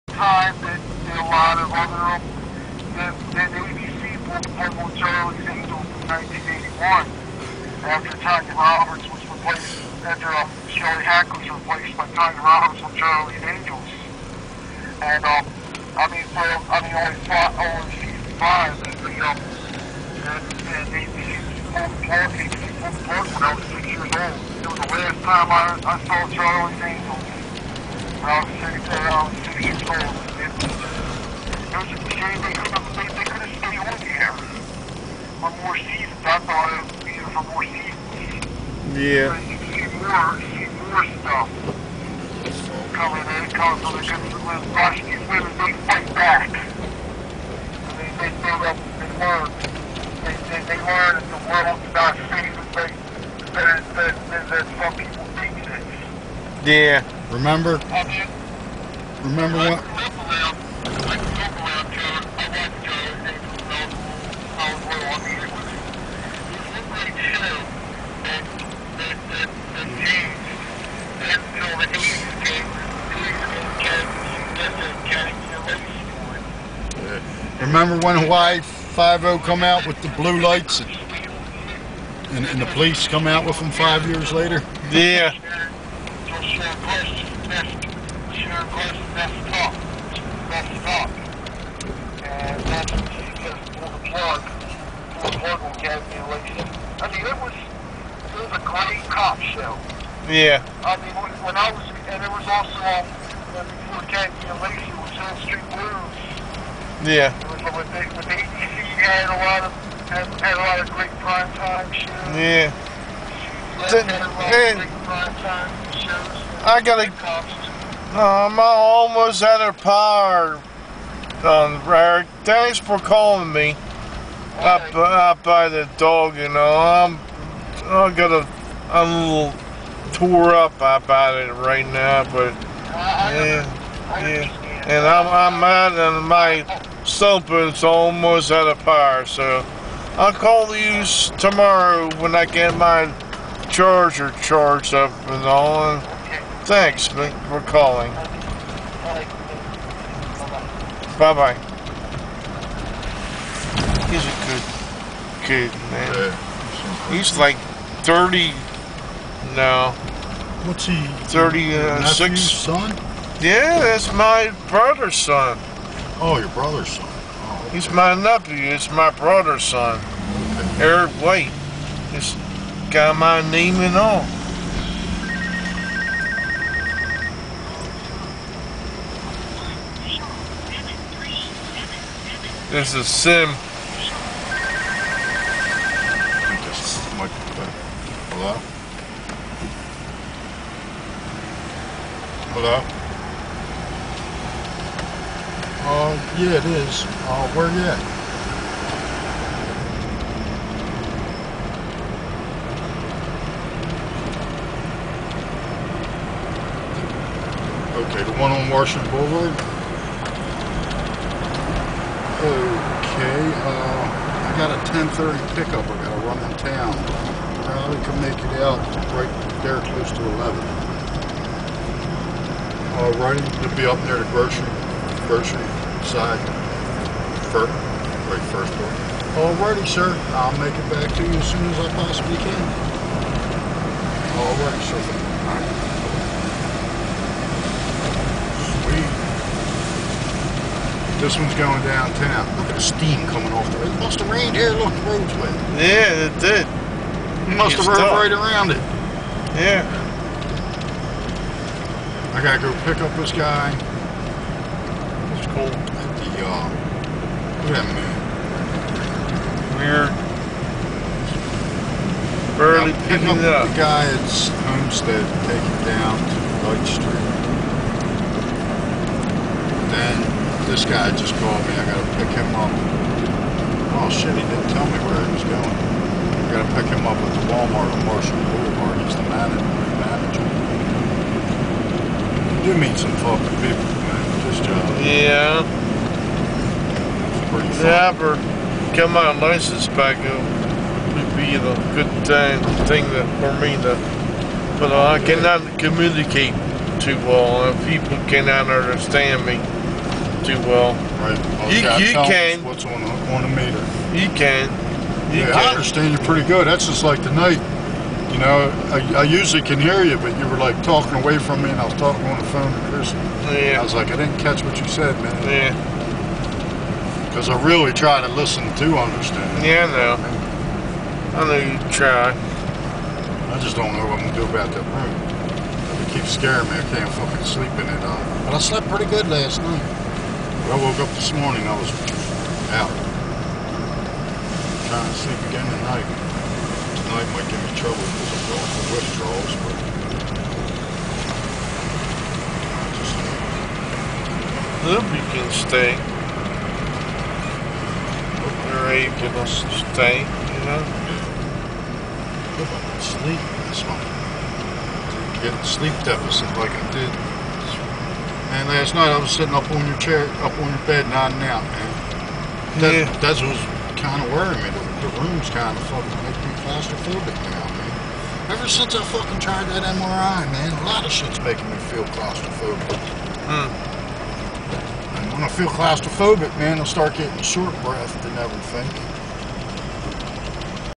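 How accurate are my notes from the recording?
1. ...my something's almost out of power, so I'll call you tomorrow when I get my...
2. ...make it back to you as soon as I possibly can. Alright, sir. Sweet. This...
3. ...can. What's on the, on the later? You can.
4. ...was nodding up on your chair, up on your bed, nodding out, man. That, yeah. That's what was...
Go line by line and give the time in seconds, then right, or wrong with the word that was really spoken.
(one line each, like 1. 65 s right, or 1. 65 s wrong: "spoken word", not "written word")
1. 136 s right
2. 230 s right
3. 302 s wrong: "meter", not "later"
4. 359 s wrong: "sitting", not "nodding".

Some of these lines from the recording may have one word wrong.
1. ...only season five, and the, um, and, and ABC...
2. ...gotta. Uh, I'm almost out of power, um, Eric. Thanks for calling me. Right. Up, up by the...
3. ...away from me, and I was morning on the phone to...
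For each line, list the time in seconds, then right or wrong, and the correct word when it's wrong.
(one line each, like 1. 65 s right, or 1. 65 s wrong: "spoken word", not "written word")
1. 17 s right
2. 116 s right
3. 311 s wrong: "talking", not "morning".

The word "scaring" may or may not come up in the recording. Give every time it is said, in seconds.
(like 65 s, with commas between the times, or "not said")
326 s.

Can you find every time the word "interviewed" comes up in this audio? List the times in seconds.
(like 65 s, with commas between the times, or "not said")
not said.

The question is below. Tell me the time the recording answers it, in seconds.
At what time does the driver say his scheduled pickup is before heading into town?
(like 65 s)
214 s.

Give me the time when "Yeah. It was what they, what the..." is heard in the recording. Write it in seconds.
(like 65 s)
107 s.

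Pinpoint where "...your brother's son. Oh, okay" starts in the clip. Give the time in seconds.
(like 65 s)
166 s.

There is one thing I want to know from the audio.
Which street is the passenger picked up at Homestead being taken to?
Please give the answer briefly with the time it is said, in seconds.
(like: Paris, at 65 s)
Light Street, at 266 s.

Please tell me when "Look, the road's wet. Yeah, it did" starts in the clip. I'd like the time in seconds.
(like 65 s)
244 s.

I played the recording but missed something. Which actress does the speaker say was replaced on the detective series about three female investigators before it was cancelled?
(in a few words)
Shelley Hack.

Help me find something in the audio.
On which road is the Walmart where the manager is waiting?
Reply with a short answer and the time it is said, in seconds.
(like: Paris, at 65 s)
Marshall Boulevard, at 278 s.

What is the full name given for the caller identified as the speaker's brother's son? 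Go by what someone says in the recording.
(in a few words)
Eric White.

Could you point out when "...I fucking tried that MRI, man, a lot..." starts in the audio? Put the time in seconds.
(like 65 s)
368 s.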